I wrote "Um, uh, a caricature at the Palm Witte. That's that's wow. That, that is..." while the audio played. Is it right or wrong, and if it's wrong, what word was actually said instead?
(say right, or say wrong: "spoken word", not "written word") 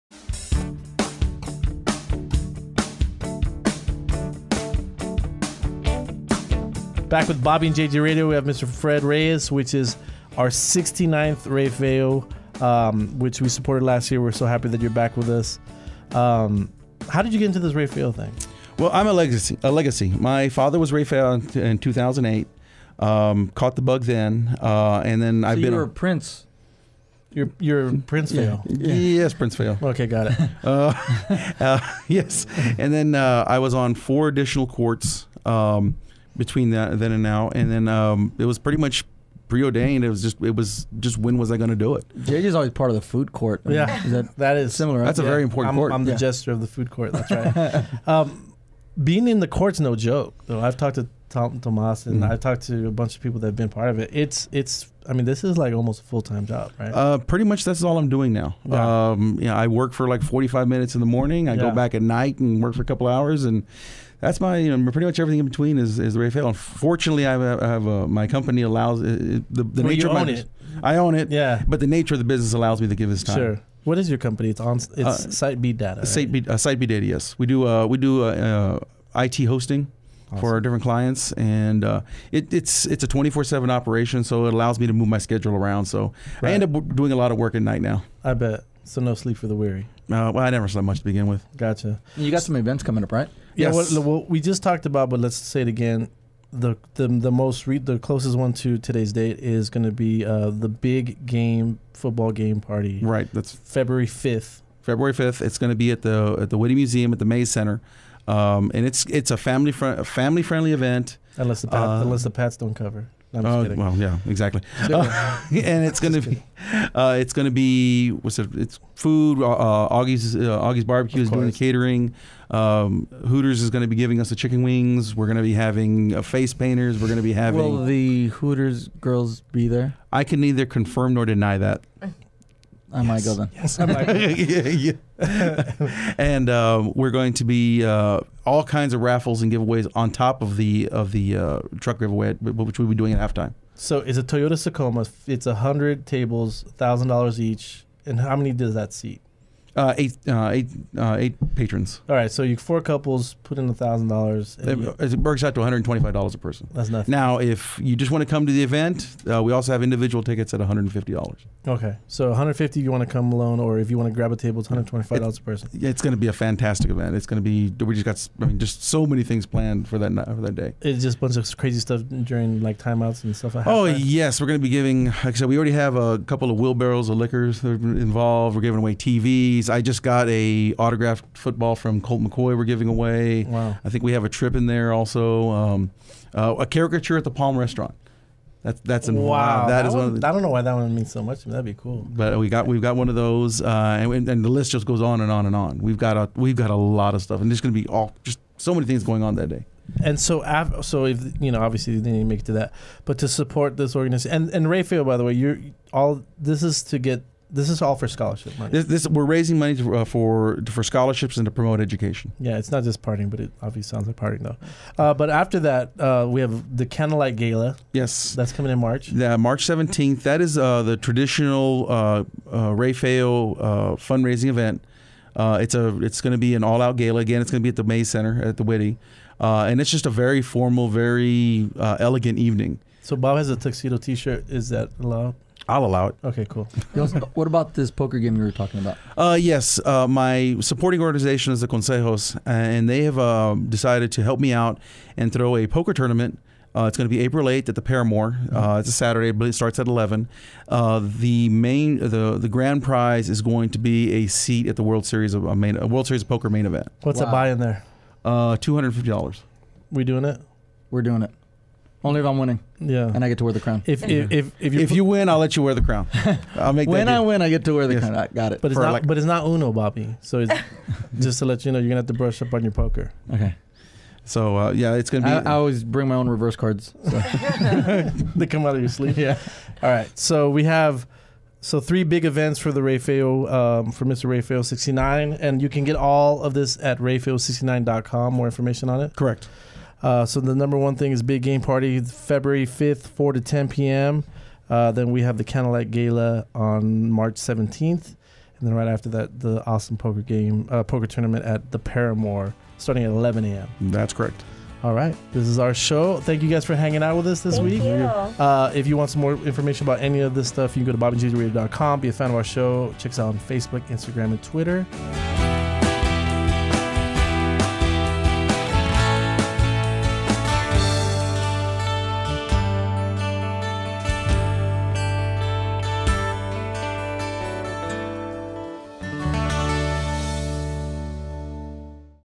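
wrong: "Restaurant", not "Witte".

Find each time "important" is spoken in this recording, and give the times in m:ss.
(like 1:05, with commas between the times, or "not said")
0:45.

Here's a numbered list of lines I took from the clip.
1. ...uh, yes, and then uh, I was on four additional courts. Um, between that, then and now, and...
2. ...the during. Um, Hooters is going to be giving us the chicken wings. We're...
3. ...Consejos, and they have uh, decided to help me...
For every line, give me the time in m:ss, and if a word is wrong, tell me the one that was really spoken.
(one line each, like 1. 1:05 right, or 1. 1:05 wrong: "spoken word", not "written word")
1. 0:31 right
2. 2:01 wrong: "catering", not "during"
3. 4:01 right.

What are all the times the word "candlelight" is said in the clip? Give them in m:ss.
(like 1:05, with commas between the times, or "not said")
3:36, 4:55.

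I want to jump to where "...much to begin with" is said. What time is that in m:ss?
1:30.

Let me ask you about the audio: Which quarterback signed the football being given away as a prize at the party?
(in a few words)
Colt McCoy.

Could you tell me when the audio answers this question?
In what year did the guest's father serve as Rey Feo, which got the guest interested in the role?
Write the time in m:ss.
0:21.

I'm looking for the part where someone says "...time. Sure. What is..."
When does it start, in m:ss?
1:13.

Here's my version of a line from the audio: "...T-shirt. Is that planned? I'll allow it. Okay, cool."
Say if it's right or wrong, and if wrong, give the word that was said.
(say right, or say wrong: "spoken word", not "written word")
wrong: "allowed", not "planned".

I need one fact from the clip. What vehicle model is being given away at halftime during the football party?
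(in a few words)
Toyota Tacoma.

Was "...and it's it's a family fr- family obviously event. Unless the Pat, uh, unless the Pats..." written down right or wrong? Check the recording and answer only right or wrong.
wrong.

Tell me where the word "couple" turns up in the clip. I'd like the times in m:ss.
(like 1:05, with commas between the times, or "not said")
1:02, 2:32, 2:56.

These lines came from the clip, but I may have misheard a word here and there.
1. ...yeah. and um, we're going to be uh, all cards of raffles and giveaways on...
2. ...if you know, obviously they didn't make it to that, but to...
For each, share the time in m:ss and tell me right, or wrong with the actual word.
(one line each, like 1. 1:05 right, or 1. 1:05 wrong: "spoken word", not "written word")
1. 2:15 wrong: "kinds", not "cards"
2. 3:21 right.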